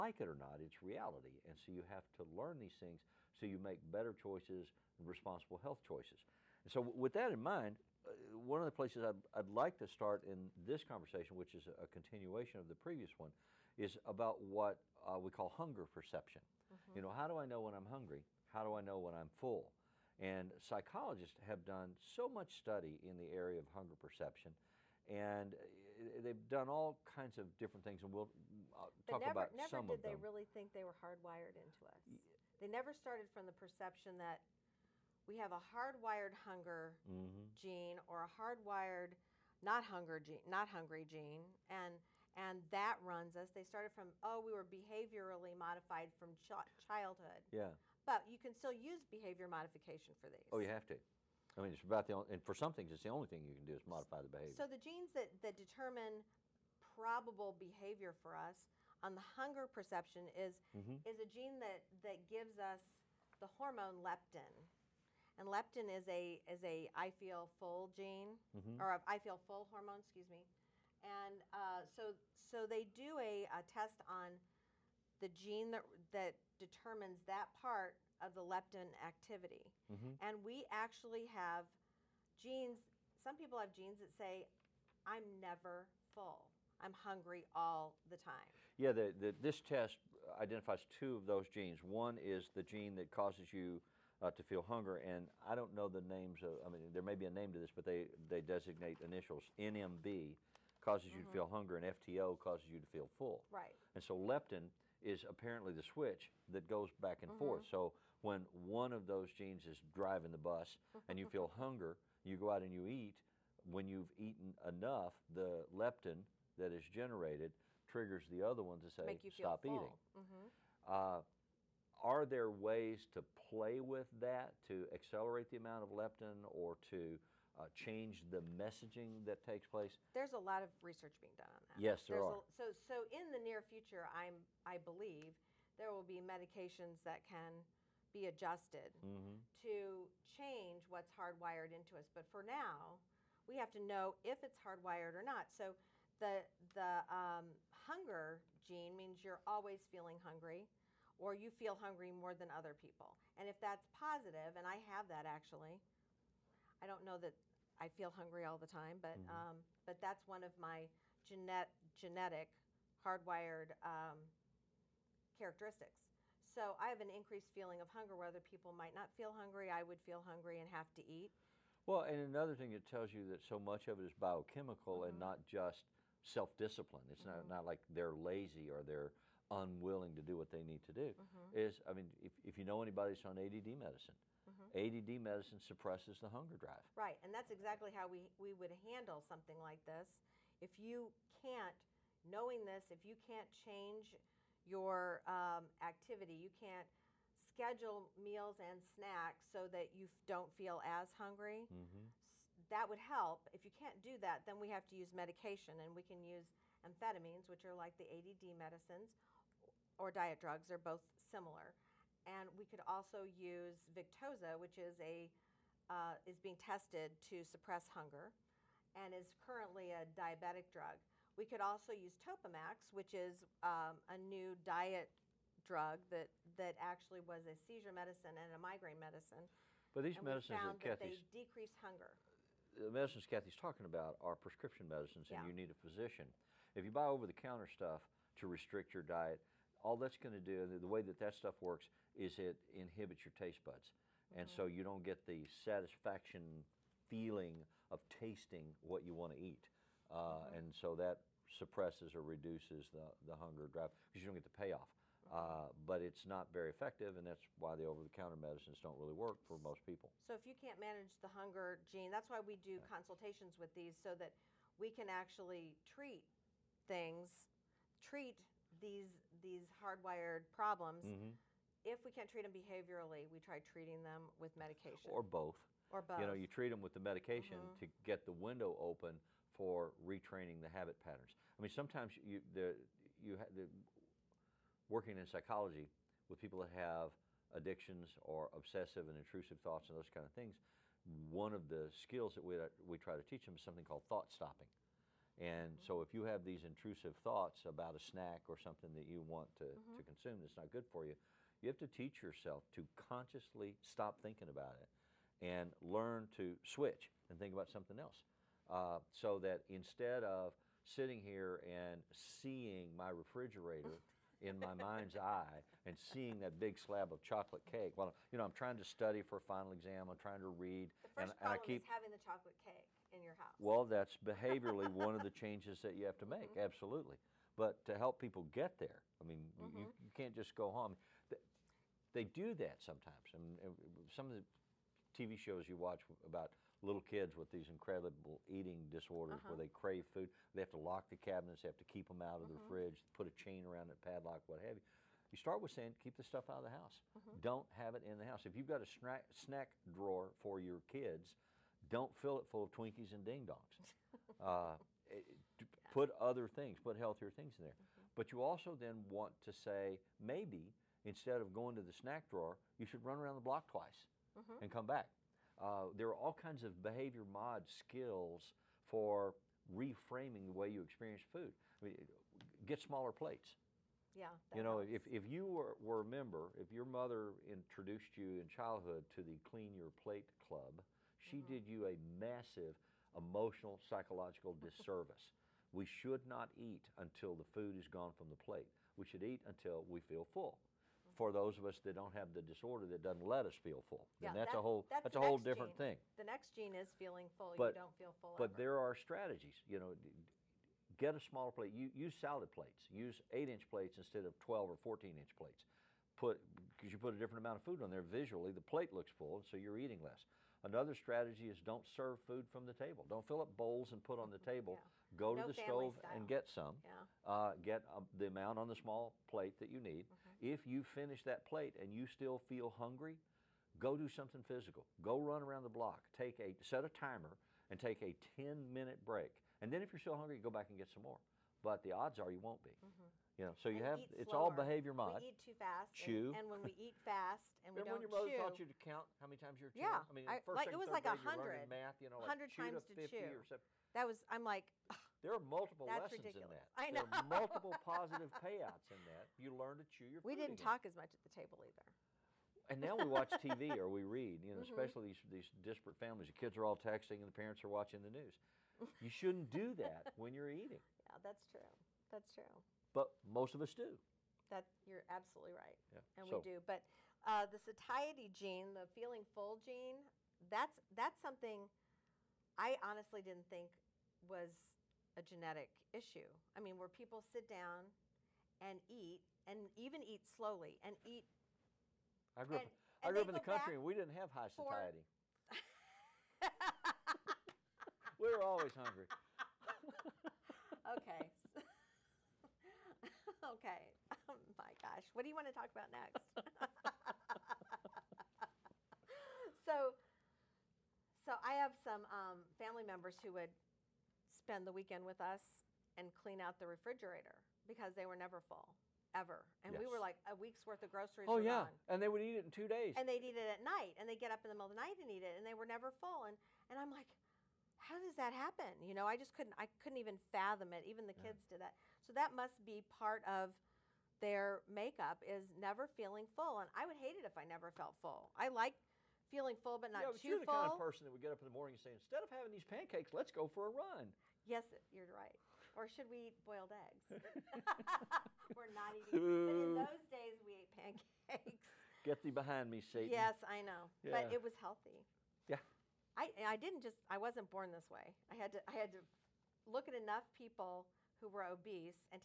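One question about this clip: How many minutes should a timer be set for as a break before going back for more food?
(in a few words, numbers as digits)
10.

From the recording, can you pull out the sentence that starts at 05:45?
You start with saying, keep the stuff out of the house.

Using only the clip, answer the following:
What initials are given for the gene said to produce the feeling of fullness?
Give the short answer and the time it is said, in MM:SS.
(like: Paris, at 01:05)
FTO, at 01:41.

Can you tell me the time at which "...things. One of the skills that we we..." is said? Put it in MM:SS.
04:50.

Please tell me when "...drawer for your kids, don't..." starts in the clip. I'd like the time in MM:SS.
05:49.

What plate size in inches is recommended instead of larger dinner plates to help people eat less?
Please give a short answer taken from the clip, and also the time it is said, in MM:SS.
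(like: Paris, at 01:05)
8 inches, at 06:43.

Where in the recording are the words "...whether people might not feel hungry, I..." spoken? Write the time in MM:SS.
02:48.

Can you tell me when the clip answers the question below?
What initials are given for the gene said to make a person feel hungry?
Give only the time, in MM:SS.
01:39.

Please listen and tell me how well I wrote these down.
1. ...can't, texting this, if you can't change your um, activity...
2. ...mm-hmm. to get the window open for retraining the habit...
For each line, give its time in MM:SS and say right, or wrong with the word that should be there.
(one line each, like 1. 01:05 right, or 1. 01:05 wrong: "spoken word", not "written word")
1. 03:11 wrong: "knowing", not "texting"
2. 04:37 right.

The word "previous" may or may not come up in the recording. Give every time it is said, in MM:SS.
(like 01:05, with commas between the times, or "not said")
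00:12.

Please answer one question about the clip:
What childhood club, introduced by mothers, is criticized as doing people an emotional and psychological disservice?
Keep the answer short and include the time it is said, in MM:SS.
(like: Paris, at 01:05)
Clean Your Plate Club, at 06:19.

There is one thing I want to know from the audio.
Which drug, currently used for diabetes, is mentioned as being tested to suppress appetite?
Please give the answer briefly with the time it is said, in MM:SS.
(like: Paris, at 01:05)
Victoza, at 03:33.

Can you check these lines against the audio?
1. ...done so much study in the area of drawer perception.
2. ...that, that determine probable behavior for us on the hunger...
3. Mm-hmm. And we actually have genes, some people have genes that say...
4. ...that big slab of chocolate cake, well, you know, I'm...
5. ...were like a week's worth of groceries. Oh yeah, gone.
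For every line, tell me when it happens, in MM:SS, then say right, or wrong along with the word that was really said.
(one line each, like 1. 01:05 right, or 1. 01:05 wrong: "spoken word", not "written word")
1. 00:21 wrong: "hunger", not "drawer"
2. 00:55 right
3. 01:19 right
4. 05:16 right
5. 08:29 right.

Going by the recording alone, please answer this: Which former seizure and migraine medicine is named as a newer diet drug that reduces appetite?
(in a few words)
Topamax.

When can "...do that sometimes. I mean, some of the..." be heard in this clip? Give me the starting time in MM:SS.
05:32.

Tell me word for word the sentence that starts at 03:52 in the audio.
The medicines Kathy's talking about are prescription medicines, and yeah.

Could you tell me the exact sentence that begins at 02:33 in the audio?
And if that's positive, and I have that actually, I don't know that I feel hungry all the time, but mm-hmm.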